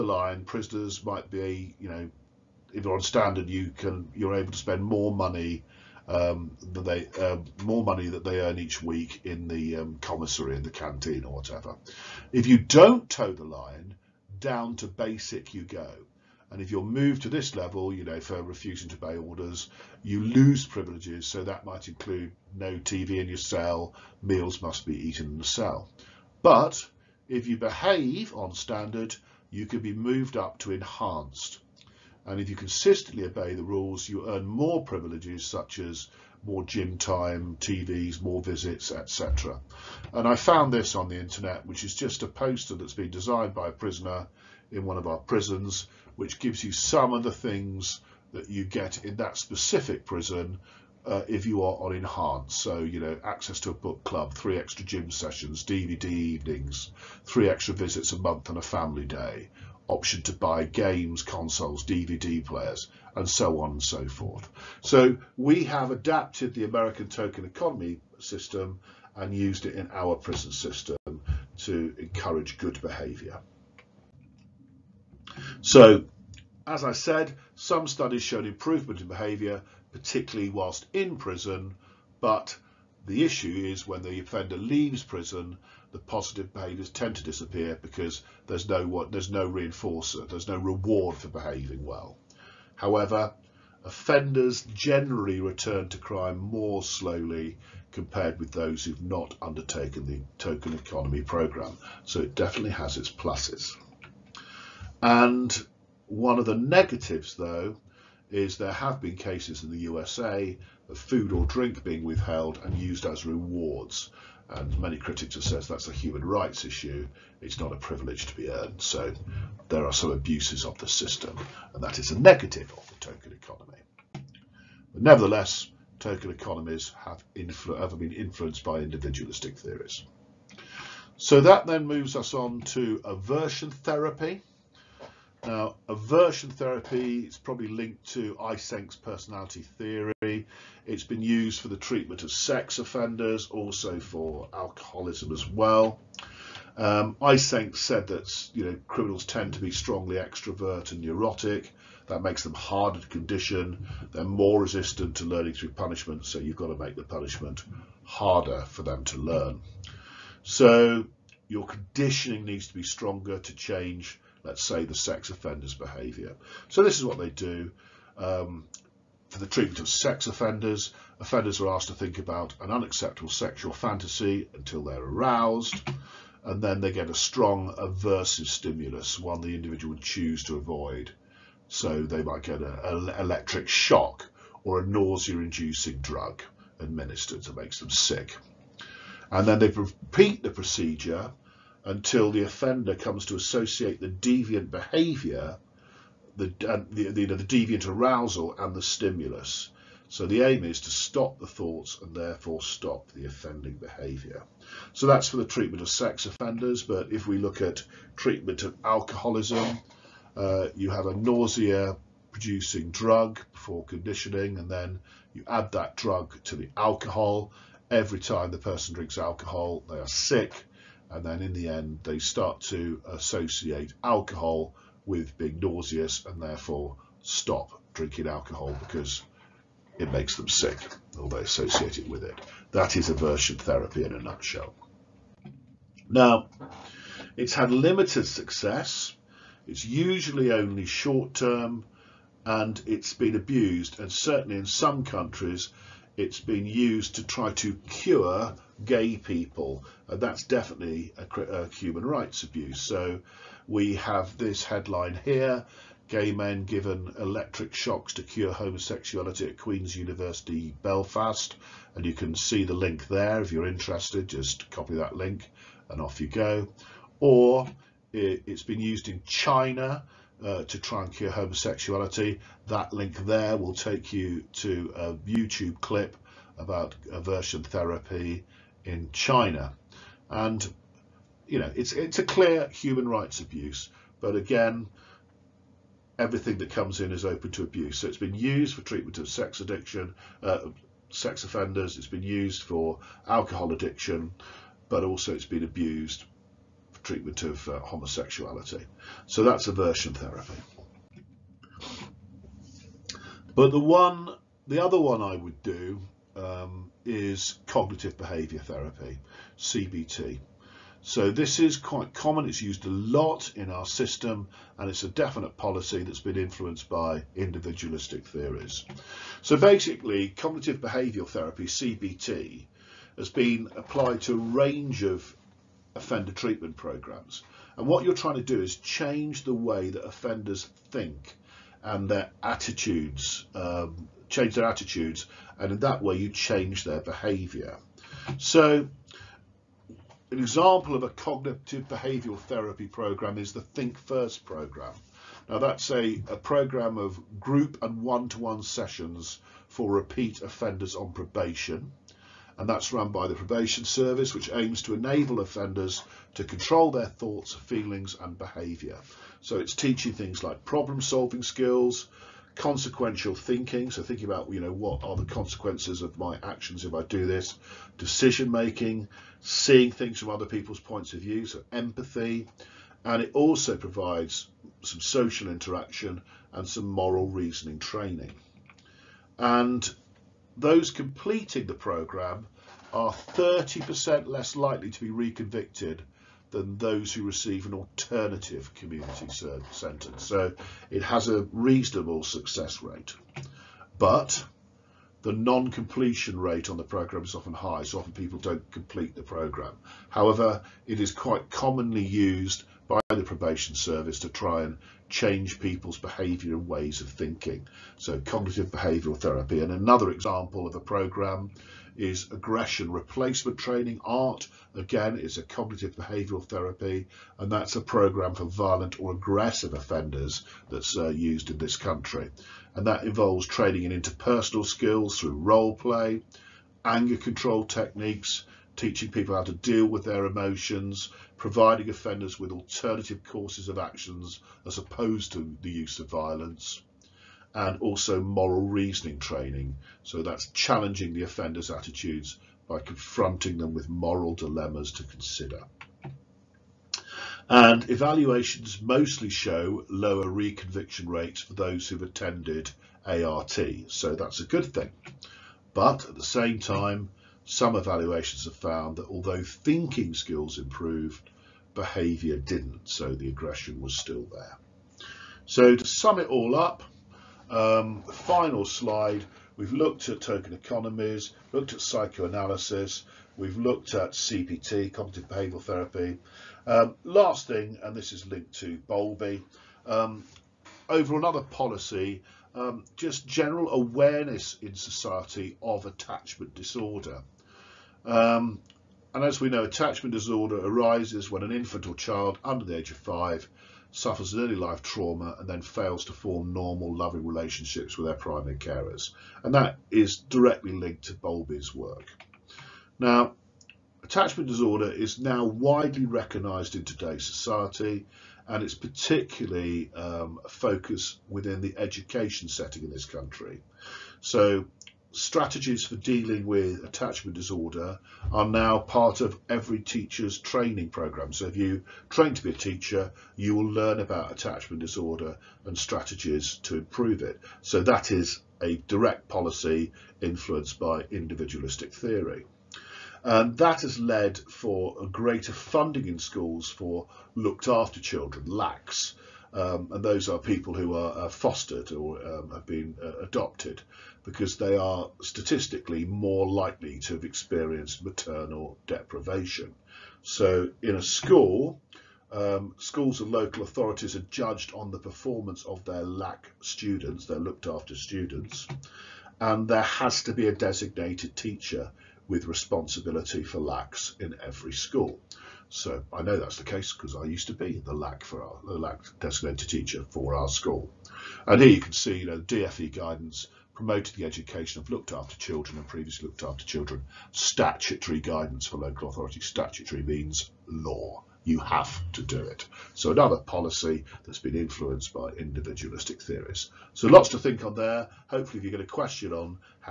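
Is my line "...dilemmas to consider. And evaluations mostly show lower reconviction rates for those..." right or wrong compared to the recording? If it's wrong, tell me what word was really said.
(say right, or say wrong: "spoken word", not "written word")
right.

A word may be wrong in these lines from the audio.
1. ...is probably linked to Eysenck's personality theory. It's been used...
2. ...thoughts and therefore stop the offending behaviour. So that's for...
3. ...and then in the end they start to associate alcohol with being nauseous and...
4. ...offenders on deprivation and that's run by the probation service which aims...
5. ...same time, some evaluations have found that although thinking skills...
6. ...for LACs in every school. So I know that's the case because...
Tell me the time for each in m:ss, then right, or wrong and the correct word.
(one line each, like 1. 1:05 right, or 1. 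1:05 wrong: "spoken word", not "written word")
1. 2:17 right
2. 3:21 right
3. 3:41 right
4. 5:50 wrong: "probation", not "deprivation"
5. 7:36 right
6. 9:23 right.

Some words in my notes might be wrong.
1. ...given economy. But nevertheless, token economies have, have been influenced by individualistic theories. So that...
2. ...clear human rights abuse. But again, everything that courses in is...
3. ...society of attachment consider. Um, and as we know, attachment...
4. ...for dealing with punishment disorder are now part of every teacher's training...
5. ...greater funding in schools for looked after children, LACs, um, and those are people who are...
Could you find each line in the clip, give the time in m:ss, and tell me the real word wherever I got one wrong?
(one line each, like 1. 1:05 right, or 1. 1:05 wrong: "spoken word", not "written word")
1. 2:02 wrong: "token", not "given"
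2. 4:42 wrong: "comes", not "courses"
3. 8:04 wrong: "disorder", not "consider"
4. 8:35 wrong: "attachment", not "punishment"
5. 8:55 right.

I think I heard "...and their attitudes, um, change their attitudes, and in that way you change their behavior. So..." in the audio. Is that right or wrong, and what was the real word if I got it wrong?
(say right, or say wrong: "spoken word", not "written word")
right.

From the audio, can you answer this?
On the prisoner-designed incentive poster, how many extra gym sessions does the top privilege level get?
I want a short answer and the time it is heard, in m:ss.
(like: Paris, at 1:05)
3, at 0:54.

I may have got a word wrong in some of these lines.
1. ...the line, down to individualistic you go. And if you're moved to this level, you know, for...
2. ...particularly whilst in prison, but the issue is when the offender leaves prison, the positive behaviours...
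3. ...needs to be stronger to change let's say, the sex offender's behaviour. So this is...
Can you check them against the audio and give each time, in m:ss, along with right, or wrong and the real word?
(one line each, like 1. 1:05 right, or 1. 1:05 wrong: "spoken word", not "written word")
1. 0:13 wrong: "basic", not "individualistic"
2. 1:19 right
3. 2:42 right.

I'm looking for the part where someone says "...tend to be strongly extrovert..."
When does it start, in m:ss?
2:29.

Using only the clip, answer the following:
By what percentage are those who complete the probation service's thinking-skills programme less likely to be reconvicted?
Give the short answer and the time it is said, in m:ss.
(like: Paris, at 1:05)
30%, at 6:23.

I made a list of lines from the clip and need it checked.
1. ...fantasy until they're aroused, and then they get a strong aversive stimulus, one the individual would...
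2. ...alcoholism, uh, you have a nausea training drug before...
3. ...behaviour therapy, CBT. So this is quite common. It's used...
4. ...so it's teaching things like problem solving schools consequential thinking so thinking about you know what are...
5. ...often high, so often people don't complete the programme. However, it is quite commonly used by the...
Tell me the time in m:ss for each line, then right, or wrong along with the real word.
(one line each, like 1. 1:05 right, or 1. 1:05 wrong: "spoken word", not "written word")
1. 2:53 right
2. 3:28 wrong: "producing", not "training"
3. 5:08 right
4. 5:59 wrong: "skills", not "schools"
5. 6:37 right.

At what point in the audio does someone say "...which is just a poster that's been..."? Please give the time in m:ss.
0:41.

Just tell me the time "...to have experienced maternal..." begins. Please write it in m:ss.
9:06.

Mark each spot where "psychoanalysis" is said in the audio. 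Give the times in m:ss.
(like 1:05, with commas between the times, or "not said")
7:51.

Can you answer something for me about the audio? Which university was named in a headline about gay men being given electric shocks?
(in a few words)
Queen's University Belfast.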